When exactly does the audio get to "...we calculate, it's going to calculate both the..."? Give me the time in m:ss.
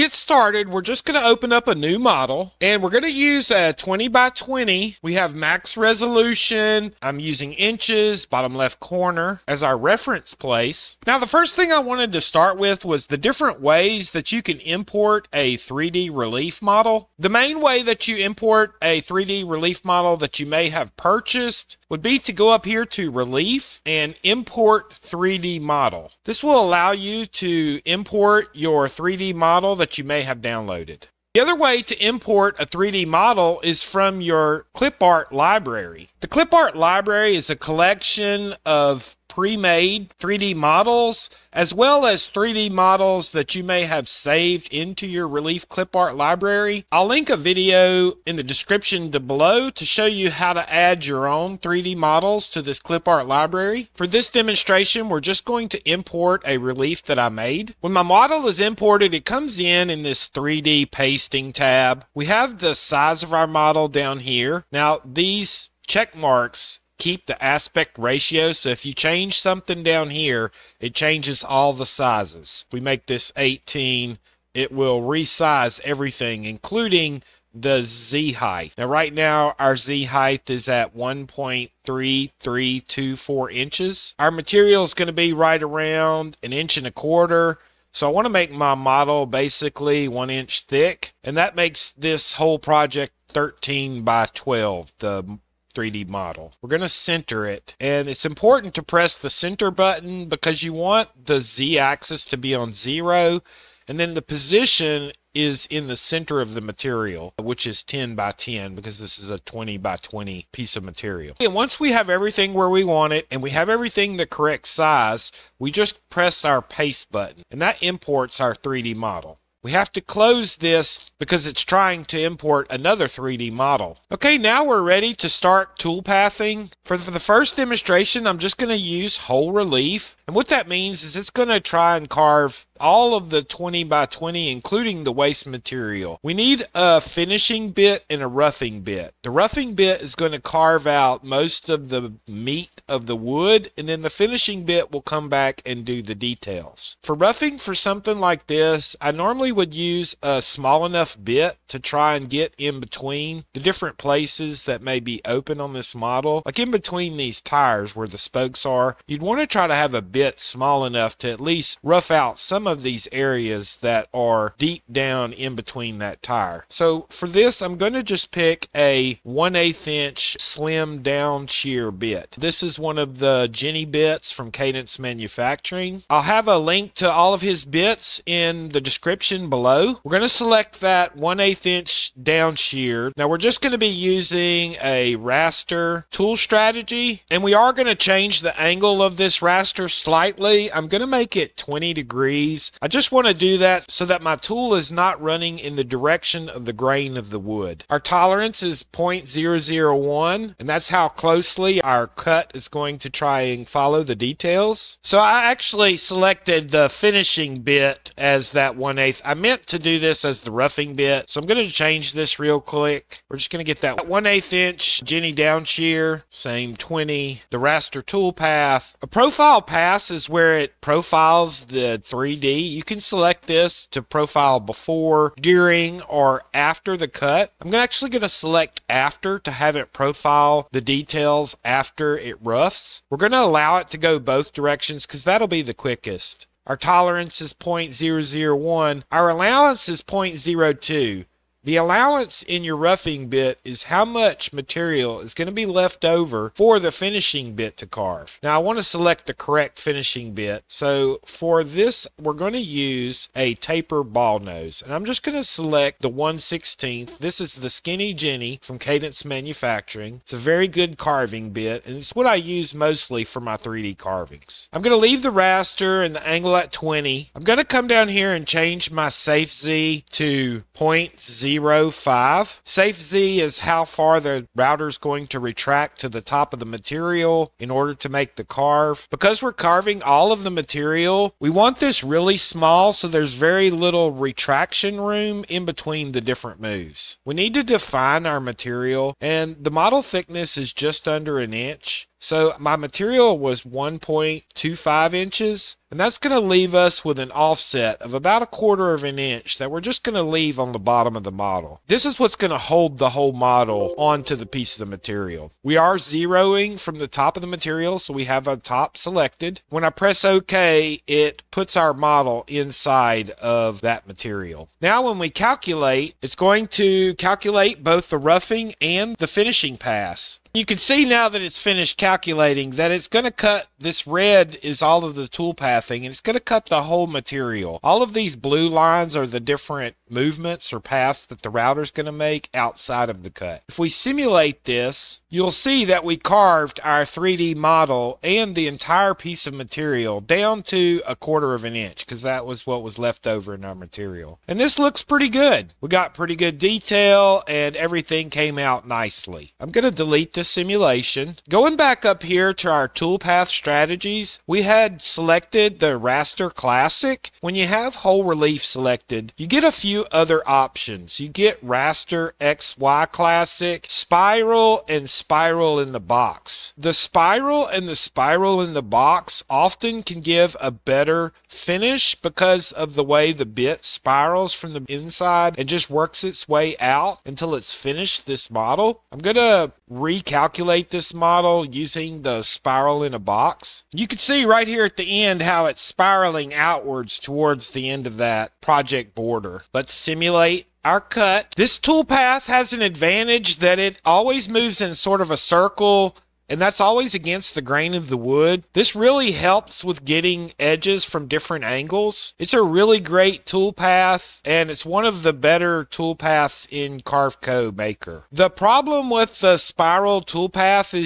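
5:15.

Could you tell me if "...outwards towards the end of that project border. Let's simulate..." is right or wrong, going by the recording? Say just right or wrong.
right.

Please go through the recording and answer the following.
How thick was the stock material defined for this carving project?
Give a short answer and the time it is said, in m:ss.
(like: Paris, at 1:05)
1.25 inches, at 4:53.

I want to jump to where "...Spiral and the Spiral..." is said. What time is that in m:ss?
6:06.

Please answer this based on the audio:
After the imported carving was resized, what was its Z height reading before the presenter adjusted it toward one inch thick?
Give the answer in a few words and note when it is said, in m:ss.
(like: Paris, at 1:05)
1.3324 inches, at 1:20.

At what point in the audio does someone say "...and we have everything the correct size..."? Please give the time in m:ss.
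1:53.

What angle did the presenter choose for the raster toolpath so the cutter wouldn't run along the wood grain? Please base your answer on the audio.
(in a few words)
20 degrees.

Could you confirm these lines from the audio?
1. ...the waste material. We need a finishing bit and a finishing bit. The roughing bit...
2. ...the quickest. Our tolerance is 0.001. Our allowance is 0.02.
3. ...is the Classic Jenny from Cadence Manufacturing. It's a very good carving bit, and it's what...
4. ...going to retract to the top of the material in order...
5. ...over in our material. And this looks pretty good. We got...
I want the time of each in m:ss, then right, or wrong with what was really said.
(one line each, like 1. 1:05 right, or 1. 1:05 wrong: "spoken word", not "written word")
1. 2:15 wrong: "roughing", not "finishing"
2. 3:55 right
3. 4:17 wrong: "Skinny", not "Classic"
4. 4:34 right
5. 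5:43 right.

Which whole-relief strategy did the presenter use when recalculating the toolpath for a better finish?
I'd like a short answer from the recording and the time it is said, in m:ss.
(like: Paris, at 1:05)
Spiral in a box, at 6:22.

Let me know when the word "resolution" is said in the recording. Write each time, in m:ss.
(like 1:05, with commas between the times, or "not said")
0:05.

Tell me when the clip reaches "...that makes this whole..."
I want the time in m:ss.
1:31.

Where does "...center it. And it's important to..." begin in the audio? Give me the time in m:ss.
1:36.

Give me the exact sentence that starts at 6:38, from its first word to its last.
This really helps with getting edges from different angles.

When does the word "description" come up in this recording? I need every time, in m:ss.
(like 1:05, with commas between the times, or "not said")
0:48, 2:58.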